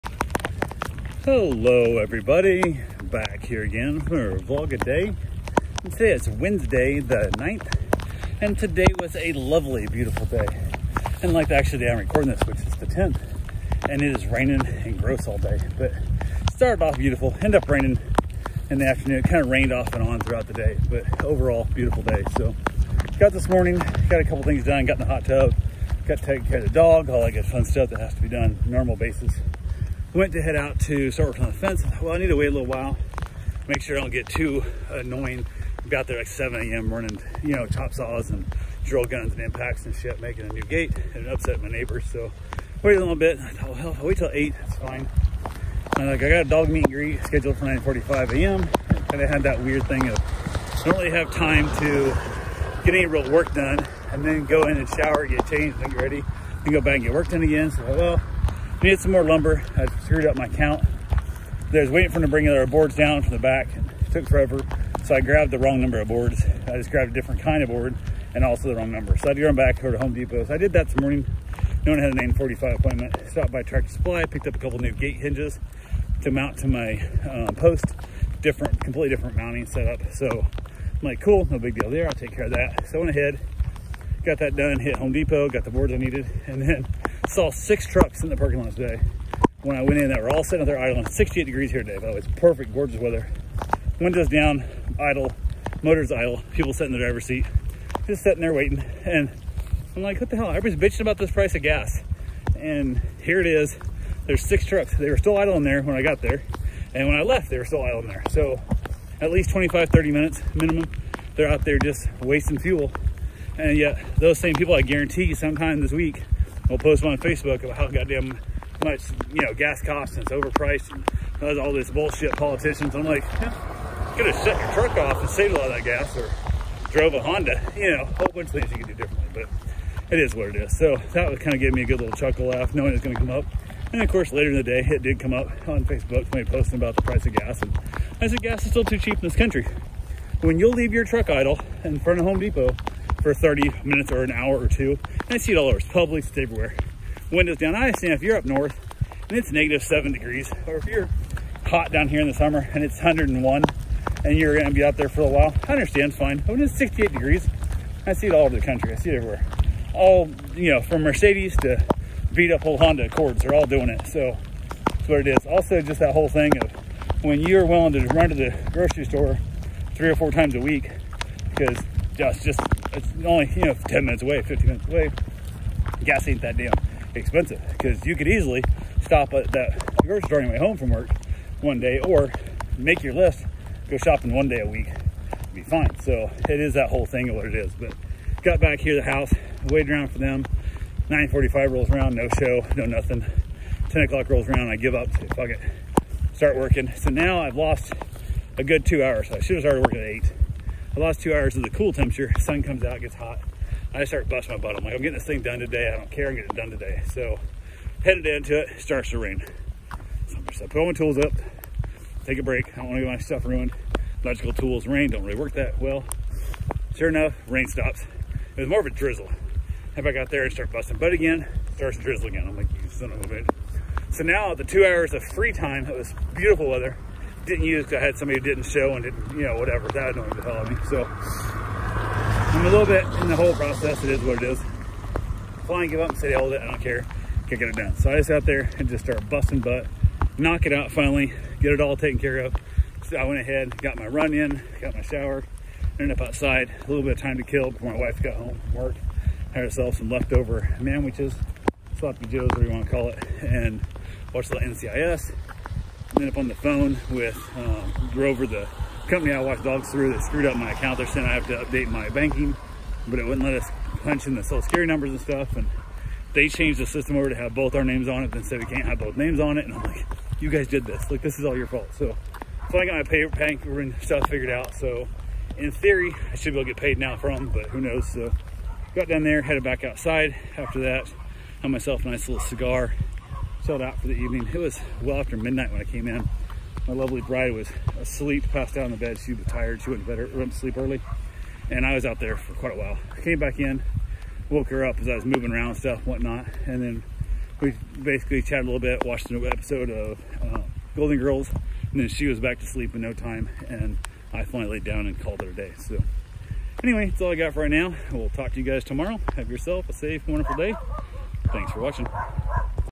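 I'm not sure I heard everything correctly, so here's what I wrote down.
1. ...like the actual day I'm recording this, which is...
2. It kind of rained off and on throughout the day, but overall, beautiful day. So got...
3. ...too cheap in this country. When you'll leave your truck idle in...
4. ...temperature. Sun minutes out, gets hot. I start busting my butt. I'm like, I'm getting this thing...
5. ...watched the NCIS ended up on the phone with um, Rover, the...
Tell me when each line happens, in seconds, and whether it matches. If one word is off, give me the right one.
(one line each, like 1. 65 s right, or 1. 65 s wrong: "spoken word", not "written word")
1. 11 s right
2. 19 s right
3. 138 s right
4. 201 s wrong: "comes", not "minutes"
5. 254 s right.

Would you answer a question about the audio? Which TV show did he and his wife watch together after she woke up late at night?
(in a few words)
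Golden Girls.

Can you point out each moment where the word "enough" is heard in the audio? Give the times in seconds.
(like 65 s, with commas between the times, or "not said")
217 s.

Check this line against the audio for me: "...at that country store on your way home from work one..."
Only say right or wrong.
wrong.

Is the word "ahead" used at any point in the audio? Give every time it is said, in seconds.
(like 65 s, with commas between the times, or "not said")
83 s, 243 s.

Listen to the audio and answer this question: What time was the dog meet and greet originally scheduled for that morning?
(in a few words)
9:45 a.m.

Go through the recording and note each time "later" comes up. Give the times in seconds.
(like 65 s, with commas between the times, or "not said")
134 s.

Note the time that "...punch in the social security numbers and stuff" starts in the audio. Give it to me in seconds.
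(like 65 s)
264 s.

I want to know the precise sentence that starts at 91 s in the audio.
68 degrees here today, by the way.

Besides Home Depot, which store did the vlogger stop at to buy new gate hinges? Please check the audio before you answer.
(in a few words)
Tractor Supply.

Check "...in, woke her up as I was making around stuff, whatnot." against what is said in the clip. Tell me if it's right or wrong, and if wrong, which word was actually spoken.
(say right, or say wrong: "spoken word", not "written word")
wrong: "moving", not "making".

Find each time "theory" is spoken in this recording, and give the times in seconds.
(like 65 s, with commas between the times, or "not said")
275 s.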